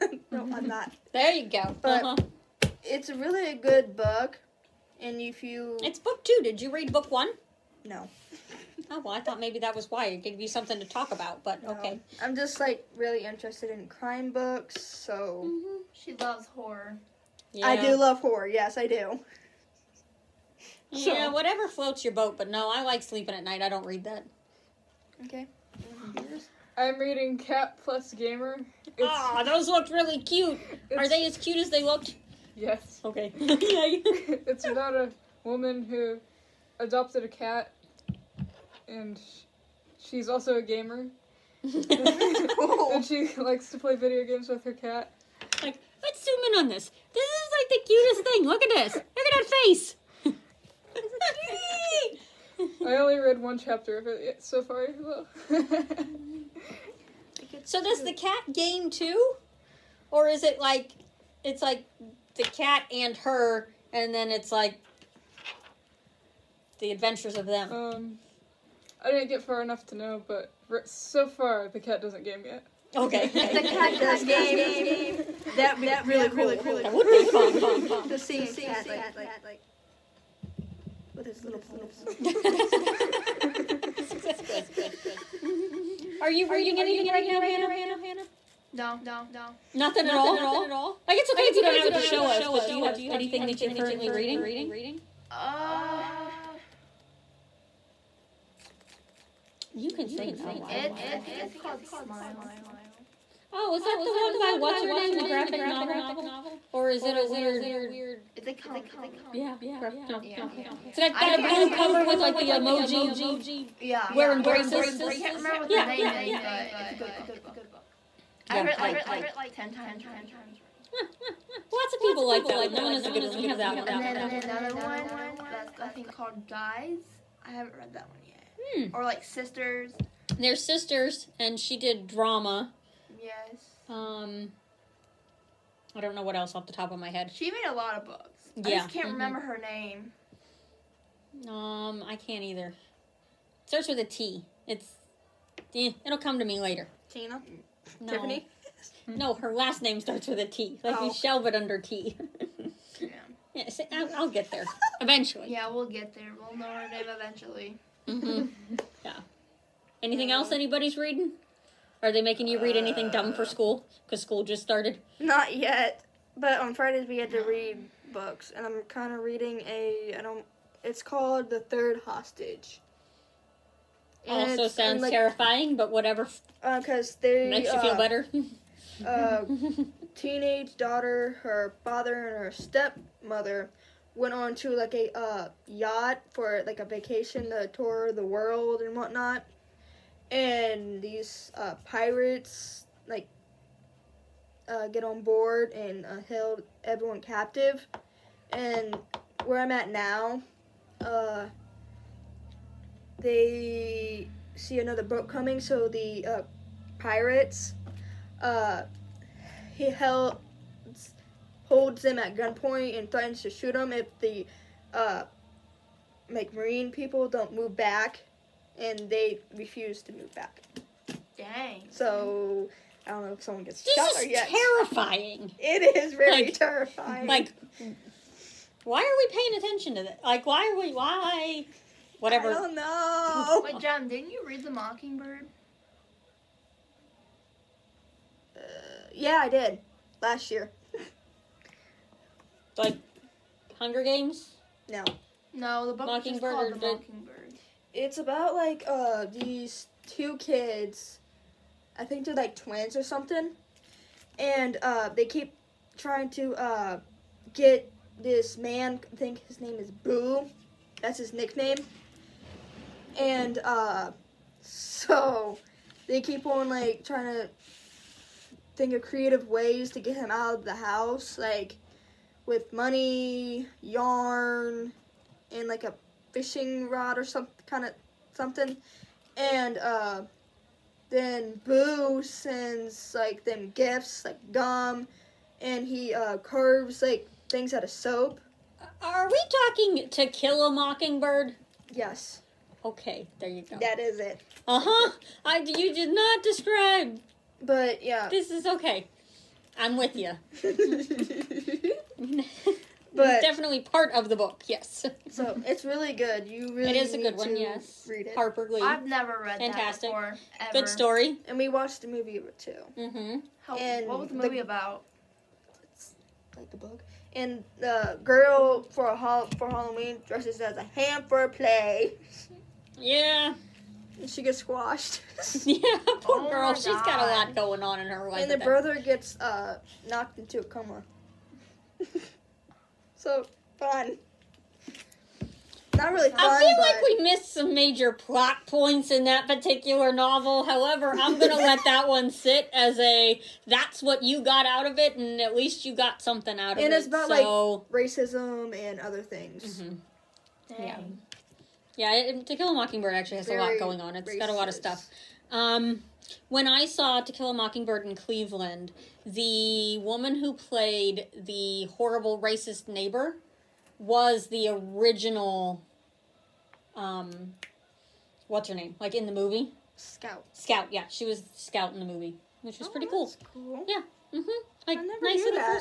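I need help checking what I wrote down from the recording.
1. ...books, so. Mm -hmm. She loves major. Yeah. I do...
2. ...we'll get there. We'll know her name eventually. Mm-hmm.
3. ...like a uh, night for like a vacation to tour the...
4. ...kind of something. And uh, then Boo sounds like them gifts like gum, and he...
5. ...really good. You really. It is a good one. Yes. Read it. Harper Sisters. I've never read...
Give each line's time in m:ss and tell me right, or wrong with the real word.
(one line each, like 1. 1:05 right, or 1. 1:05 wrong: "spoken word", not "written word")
1. 0:14 wrong: "horror", not "major"
2. 2:35 right
3. 3:04 wrong: "yacht", not "night"
4. 4:37 wrong: "sends", not "sounds"
5. 5:05 wrong: "Lee", not "Sisters".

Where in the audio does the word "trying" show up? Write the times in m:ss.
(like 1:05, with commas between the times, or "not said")
4:15, 4:27.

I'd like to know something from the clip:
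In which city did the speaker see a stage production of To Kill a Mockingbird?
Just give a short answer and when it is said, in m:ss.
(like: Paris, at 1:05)
Cleveland, at 5:58.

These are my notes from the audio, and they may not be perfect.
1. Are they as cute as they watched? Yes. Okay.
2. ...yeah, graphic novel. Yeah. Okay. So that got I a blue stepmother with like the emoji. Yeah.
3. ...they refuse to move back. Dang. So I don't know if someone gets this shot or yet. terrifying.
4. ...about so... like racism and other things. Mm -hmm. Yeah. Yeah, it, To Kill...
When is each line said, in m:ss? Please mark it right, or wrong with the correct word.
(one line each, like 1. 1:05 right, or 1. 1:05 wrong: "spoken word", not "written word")
1. 0:30 wrong: "looked", not "watched"
2. 1:49 wrong: "cover", not "stepmother"
3. 3:39 right
4. 5:47 right.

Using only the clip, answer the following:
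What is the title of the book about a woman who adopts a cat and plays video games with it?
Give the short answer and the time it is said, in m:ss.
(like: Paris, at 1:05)
Cat Plus Gamer, at 0:27.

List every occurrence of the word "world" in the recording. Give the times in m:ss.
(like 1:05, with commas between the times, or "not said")
3:08.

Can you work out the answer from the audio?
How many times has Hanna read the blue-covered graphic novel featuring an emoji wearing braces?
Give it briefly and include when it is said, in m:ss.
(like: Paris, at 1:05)
10, at 1:59.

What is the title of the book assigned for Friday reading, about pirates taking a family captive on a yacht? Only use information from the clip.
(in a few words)
The Third Hostage.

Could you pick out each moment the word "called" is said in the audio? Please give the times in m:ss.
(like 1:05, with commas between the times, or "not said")
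1:41, 2:06, 2:51, 4:06.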